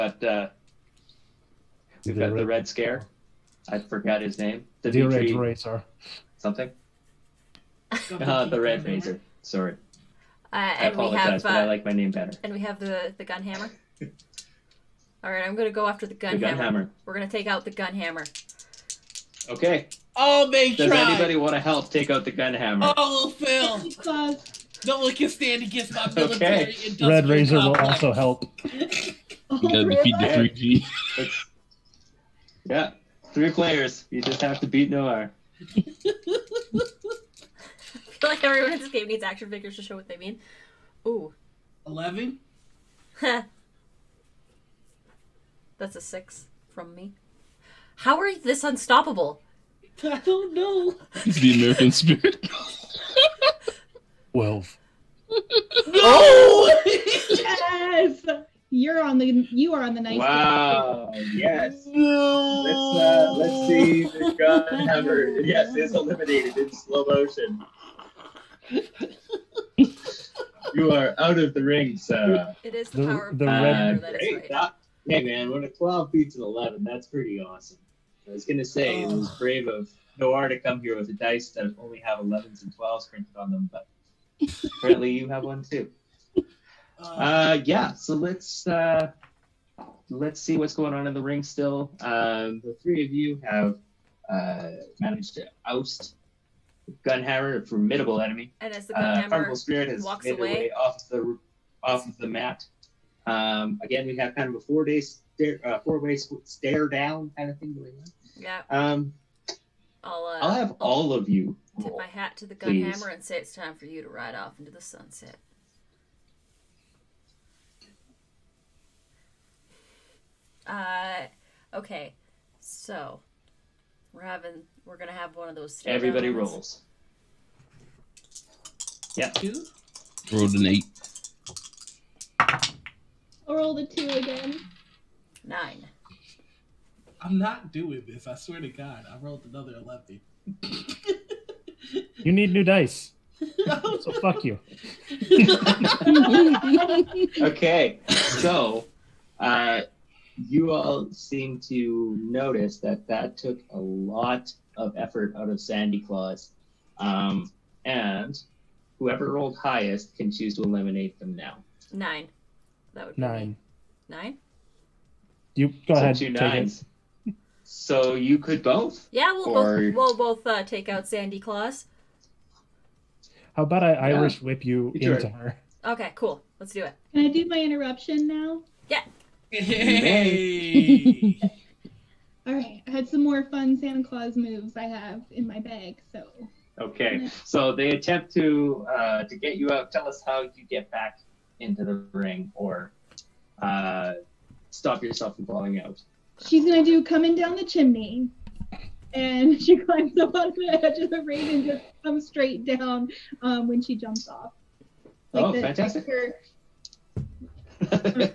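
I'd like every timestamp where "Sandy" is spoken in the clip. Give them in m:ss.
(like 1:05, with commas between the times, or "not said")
2:35, 2:51.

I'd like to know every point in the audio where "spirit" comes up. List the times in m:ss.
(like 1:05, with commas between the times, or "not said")
0:51, 1:39.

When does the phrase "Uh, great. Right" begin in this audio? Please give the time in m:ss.
1:14.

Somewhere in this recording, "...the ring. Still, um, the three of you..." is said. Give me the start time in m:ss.
1:31.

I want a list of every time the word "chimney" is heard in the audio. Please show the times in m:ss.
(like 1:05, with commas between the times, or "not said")
3:17.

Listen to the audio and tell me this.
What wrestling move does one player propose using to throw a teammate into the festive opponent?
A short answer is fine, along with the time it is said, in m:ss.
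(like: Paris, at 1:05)
Irish whip, at 2:53.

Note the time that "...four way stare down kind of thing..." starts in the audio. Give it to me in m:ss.
1:45.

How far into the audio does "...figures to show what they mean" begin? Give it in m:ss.
0:39.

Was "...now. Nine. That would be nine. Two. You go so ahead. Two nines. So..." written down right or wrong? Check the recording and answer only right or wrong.
wrong.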